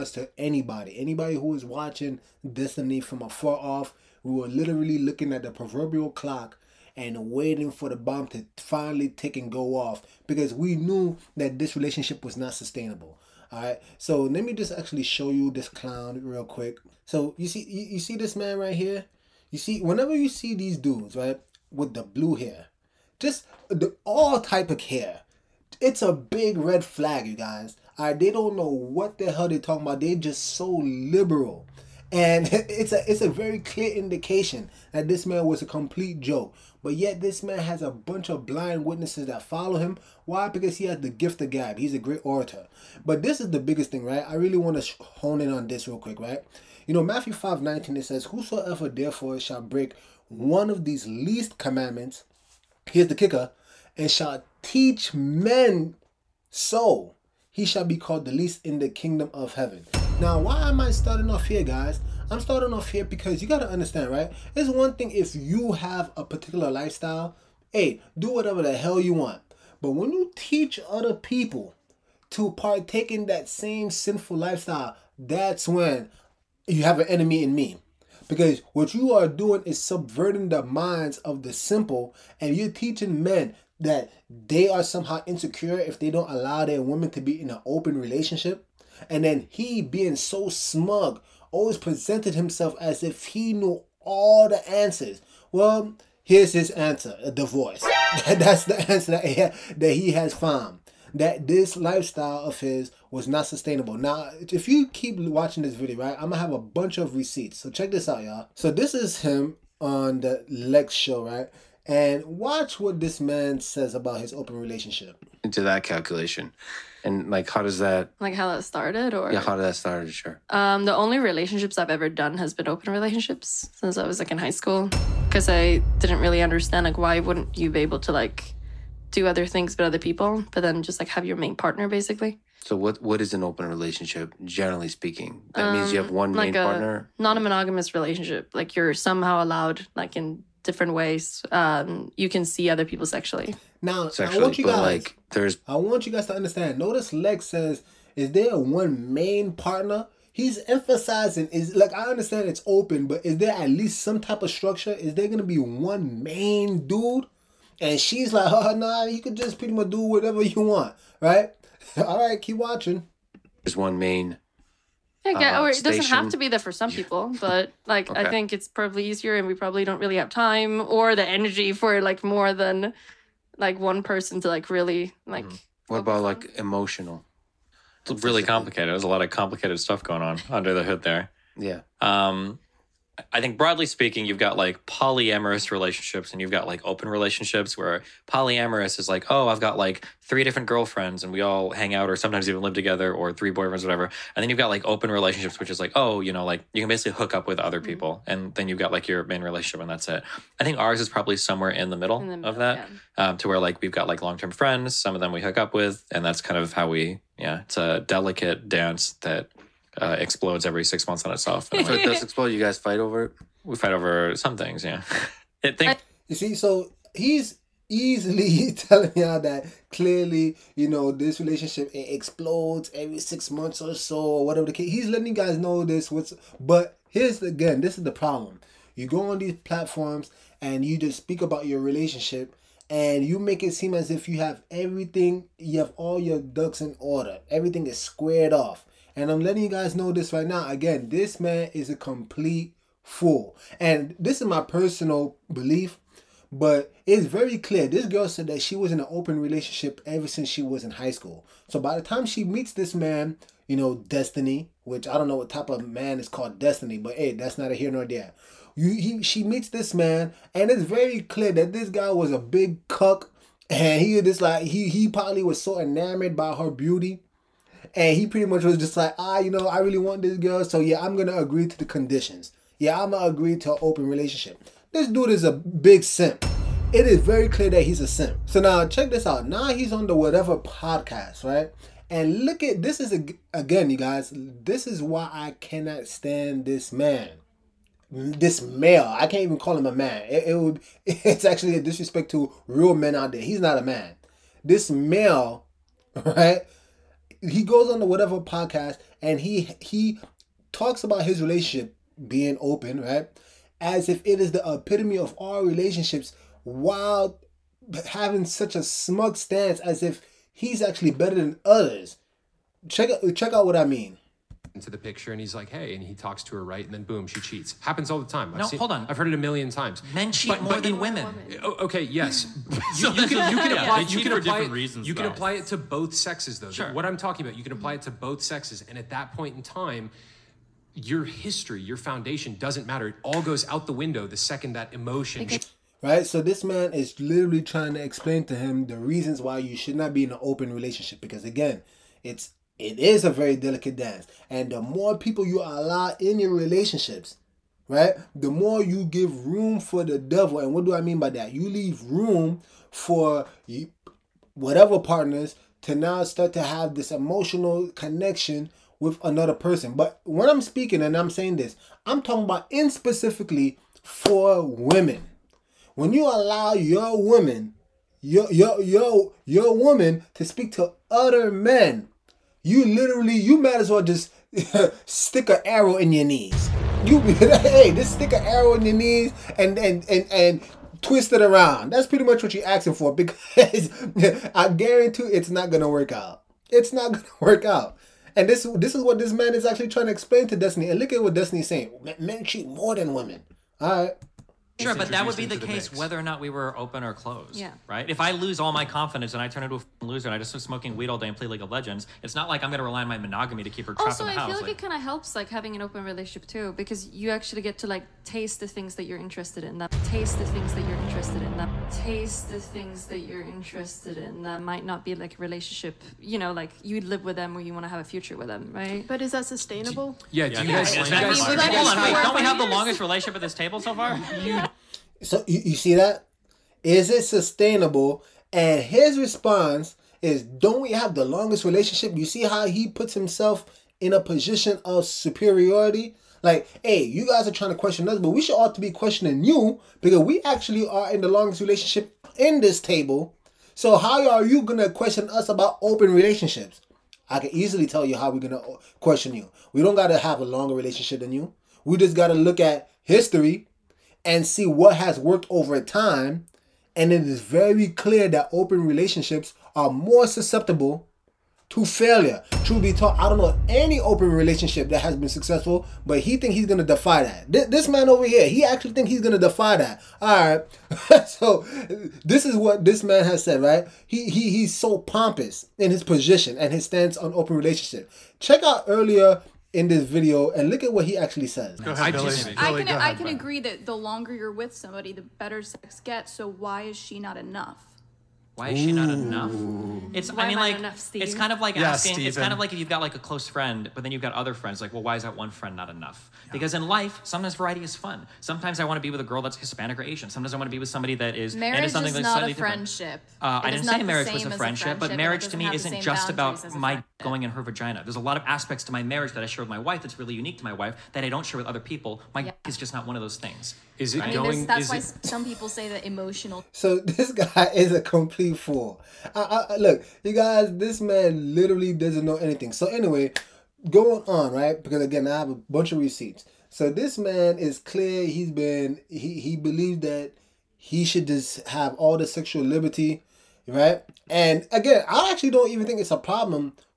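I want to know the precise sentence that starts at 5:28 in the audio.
And at that point in time, your history, your foundation doesn't matter.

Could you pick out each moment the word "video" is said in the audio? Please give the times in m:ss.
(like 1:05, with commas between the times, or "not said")
1:45, 8:00.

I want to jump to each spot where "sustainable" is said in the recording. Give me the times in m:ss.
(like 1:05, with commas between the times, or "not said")
0:12, 1:43, 6:59, 7:07.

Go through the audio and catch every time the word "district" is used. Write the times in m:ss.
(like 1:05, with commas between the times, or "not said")
not said.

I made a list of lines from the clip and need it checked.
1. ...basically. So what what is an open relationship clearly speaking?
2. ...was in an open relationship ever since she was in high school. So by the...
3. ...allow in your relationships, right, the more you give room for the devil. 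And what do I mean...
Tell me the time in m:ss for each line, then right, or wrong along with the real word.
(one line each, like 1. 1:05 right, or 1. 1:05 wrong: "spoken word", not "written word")
1. 2:11 wrong: "generally", not "clearly"
2. 4:08 right
3. 5:45 right.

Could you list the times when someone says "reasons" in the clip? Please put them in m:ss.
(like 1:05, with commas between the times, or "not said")
5:24, 5:38.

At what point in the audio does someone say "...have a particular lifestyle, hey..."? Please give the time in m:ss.
1:05.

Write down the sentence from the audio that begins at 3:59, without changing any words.
And I'm letting you guys know this right now.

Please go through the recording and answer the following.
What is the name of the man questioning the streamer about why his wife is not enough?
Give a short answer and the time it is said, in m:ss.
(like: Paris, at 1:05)
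Steve, at 8:10.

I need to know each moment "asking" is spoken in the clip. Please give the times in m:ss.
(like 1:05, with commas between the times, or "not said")
6:22, 8:11.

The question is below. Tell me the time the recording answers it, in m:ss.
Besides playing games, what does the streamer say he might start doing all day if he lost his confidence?
6:40.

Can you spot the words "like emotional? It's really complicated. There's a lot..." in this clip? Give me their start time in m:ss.
2:56.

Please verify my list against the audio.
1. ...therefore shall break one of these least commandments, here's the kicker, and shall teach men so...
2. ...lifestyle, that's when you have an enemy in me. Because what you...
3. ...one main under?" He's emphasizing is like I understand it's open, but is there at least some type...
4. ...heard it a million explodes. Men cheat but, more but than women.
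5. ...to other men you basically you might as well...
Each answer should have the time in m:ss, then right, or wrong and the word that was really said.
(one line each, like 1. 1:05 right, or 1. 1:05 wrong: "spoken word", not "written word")
1. 0:48 right
2. 1:14 right
3. 2:28 wrong: "partner", not "under"
4. 5:19 wrong: "times", not "explodes"
5. 6:10 wrong: "literally", not "basically".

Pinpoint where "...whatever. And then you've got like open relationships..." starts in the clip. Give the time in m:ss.
3:13.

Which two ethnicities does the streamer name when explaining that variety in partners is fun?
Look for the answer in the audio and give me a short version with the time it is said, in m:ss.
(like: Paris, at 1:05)
Hispanic or Asian, at 8:19.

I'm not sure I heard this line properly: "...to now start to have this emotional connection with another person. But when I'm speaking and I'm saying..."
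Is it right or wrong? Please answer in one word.
right.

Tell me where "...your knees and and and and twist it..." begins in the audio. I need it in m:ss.
6:18.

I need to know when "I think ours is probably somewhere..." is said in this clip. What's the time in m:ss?
3:20.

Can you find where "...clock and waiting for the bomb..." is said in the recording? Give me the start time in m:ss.
0:06.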